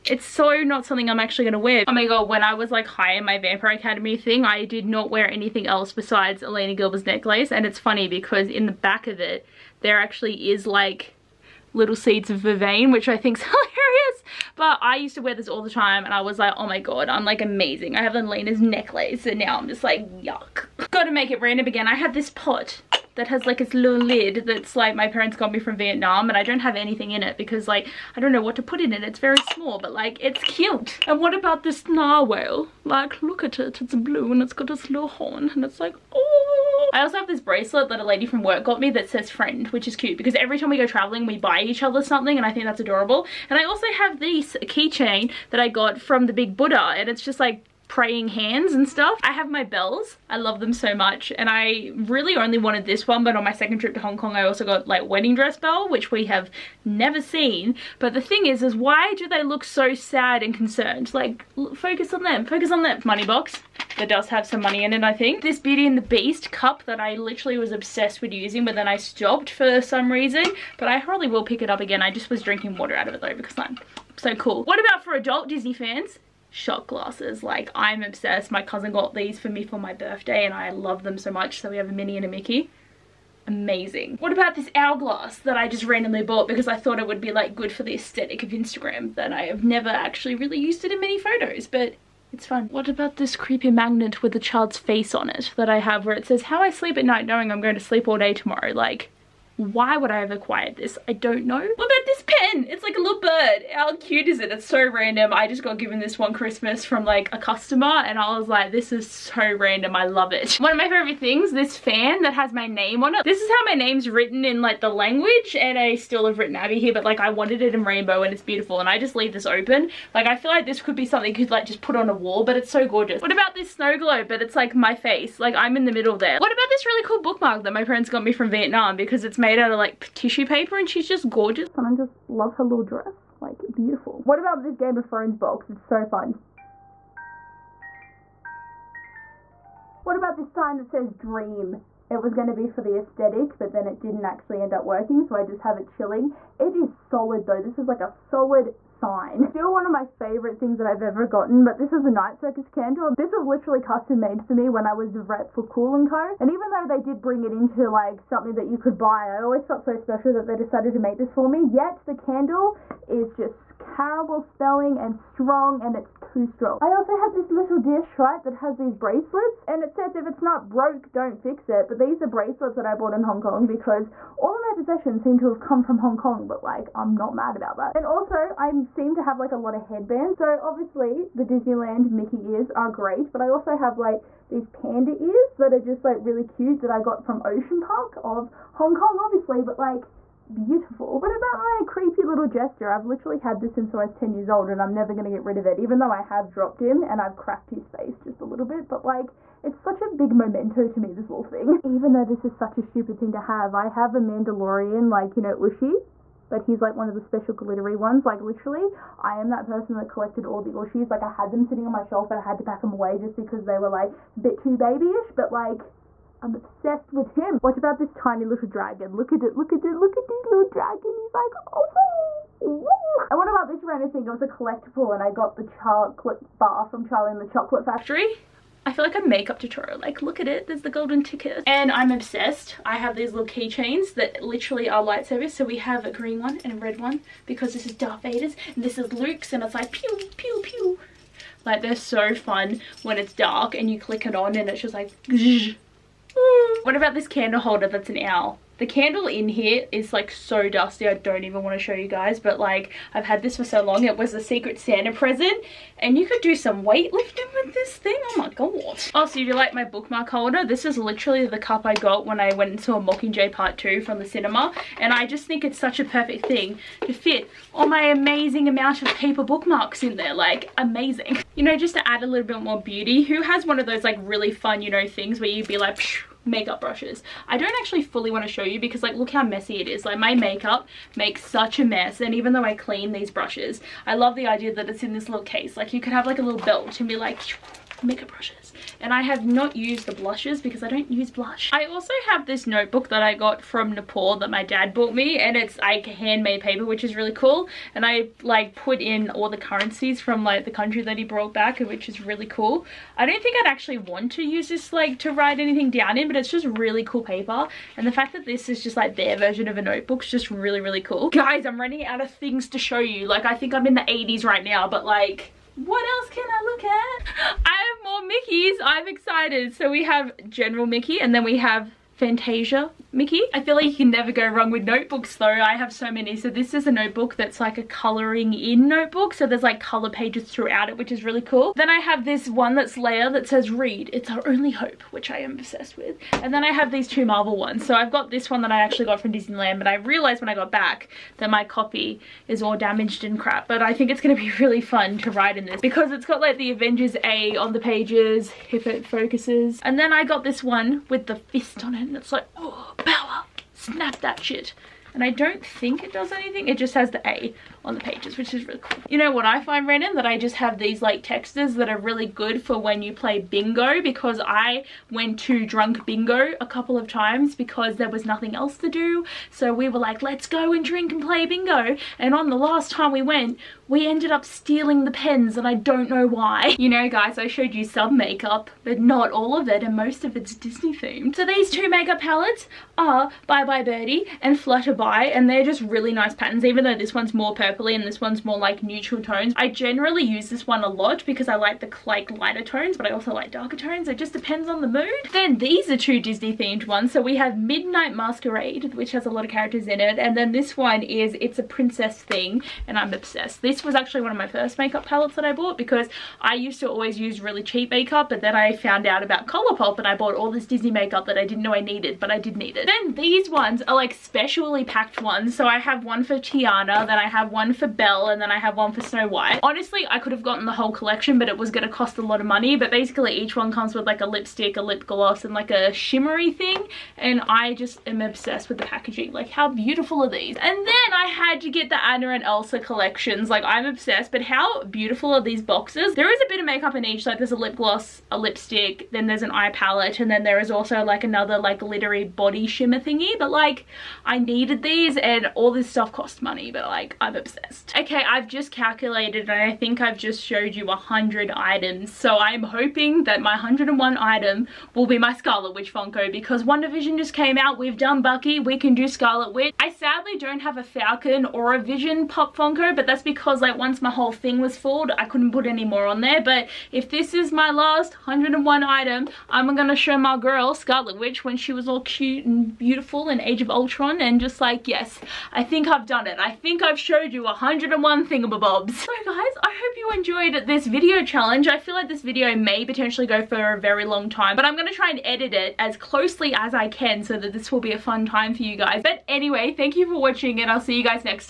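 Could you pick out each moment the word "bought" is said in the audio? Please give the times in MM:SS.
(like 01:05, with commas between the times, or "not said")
01:26, 02:52, 04:54, 06:45, 06:50.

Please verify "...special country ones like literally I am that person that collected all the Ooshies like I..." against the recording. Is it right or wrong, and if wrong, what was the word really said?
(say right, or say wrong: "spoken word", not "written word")
wrong: "glittery", not "country".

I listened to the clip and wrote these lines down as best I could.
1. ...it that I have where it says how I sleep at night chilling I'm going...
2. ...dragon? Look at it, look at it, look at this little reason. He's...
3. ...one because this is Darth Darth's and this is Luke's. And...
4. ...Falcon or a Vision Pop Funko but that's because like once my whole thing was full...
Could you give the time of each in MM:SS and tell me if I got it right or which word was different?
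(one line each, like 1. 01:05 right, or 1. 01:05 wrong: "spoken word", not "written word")
1. 01:35 wrong: "knowing", not "chilling"
2. 03:38 wrong: "dragon", not "reason"
3. 03:56 wrong: "Vader", not "Darth"
4. 07:40 right.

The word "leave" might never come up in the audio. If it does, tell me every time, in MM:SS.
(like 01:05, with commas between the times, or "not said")
01:59.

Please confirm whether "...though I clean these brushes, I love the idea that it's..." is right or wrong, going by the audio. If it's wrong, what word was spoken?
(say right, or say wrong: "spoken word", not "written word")
right.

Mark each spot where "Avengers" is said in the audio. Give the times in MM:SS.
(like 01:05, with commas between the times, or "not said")
05:46.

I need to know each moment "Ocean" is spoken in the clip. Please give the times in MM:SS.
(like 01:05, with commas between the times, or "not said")
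03:07.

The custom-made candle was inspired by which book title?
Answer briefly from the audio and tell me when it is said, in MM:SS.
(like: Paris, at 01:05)
Night Circus, at 02:32.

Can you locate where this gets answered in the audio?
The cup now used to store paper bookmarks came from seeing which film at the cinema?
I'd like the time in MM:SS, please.
04:23.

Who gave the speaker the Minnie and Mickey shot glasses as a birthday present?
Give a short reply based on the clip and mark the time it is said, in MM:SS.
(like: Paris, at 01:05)
my cousin, at 01:18.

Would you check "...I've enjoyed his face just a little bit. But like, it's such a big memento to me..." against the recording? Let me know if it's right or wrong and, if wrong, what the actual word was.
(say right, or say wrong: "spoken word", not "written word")
wrong: "cracked", not "enjoyed".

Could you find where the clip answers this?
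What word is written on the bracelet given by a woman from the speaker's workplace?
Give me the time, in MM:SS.
00:39.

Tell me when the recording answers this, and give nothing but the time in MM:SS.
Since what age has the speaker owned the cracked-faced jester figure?
03:14.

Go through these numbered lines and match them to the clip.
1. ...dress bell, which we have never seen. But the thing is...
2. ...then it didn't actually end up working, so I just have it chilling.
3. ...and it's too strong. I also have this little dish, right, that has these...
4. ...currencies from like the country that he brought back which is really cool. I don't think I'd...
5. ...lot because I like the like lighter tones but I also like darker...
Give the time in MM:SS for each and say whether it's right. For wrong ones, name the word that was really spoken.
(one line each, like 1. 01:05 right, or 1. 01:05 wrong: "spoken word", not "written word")
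1. 00:55 right
2. 02:23 right
3. 02:45 right
4. 04:59 right
5. 06:30 right.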